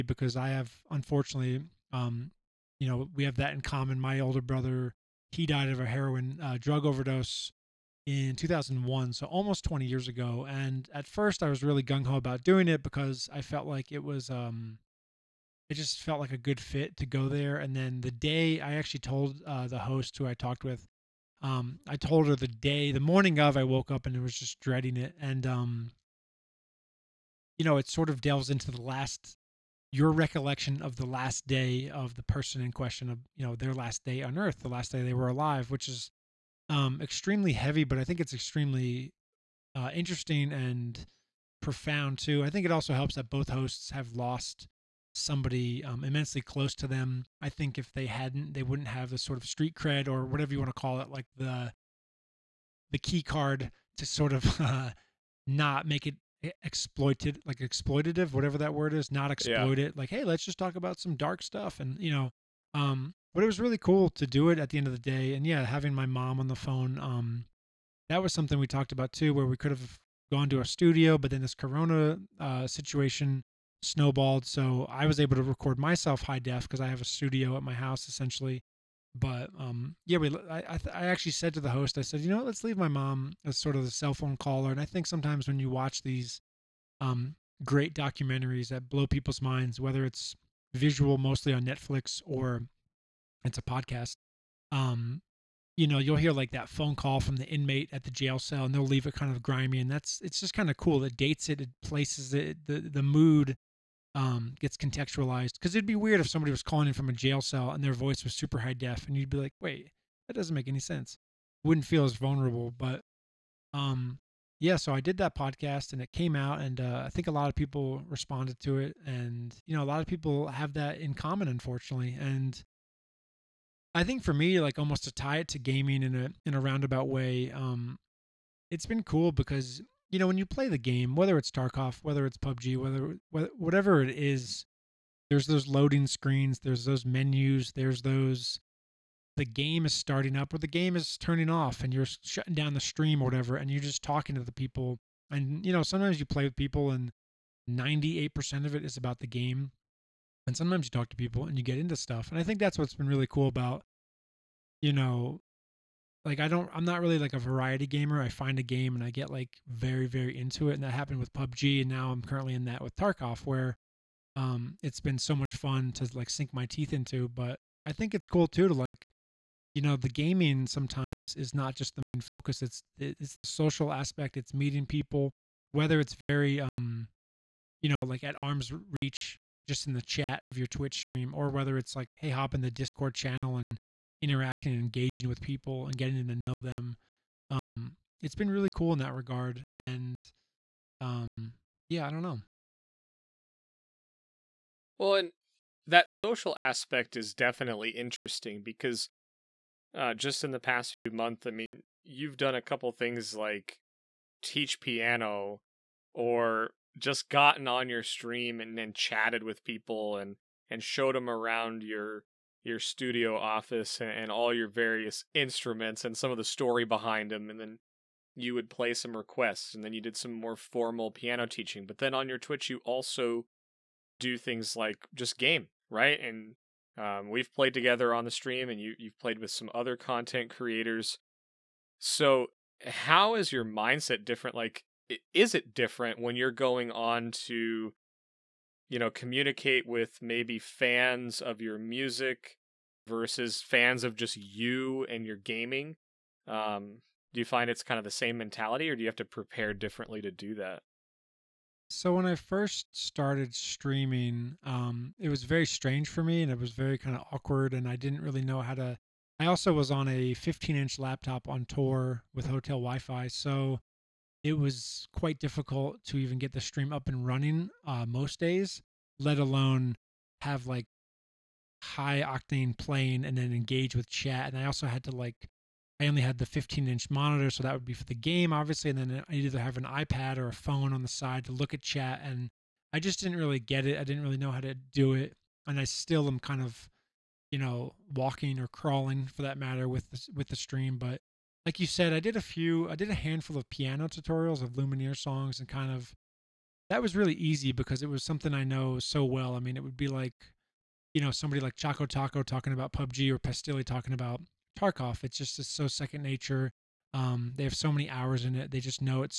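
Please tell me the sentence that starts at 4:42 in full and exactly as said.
And I just didn't really get it.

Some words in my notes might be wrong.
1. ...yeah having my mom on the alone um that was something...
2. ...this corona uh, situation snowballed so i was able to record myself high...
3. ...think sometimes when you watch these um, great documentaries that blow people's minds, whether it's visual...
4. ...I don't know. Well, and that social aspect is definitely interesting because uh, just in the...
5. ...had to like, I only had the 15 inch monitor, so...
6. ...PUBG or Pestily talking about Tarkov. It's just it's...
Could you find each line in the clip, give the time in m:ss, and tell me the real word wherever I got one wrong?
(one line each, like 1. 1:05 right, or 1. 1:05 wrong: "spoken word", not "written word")
1. 1:05 wrong: "phone", not "alone"
2. 1:11 right
3. 1:24 right
4. 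3:12 right
5. 4:34 right
6. 5:02 right.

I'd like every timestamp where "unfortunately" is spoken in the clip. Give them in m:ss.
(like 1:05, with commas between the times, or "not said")
0:00, 2:01.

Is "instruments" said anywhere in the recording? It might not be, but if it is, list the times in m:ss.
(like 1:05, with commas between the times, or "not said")
3:35.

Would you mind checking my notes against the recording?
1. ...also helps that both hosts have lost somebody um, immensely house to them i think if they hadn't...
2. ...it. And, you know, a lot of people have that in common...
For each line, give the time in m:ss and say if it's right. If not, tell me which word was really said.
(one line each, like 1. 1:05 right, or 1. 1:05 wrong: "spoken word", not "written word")
1. 0:42 wrong: "close", not "house"
2. 1:58 right.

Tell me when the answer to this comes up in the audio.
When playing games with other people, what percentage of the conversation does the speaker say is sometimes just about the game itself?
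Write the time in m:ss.
2:27.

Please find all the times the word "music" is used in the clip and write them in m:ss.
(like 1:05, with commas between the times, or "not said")
4:01.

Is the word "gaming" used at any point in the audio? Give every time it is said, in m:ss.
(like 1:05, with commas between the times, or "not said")
2:05, 2:50, 4:05.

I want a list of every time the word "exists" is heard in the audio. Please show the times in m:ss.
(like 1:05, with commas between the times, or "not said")
not said.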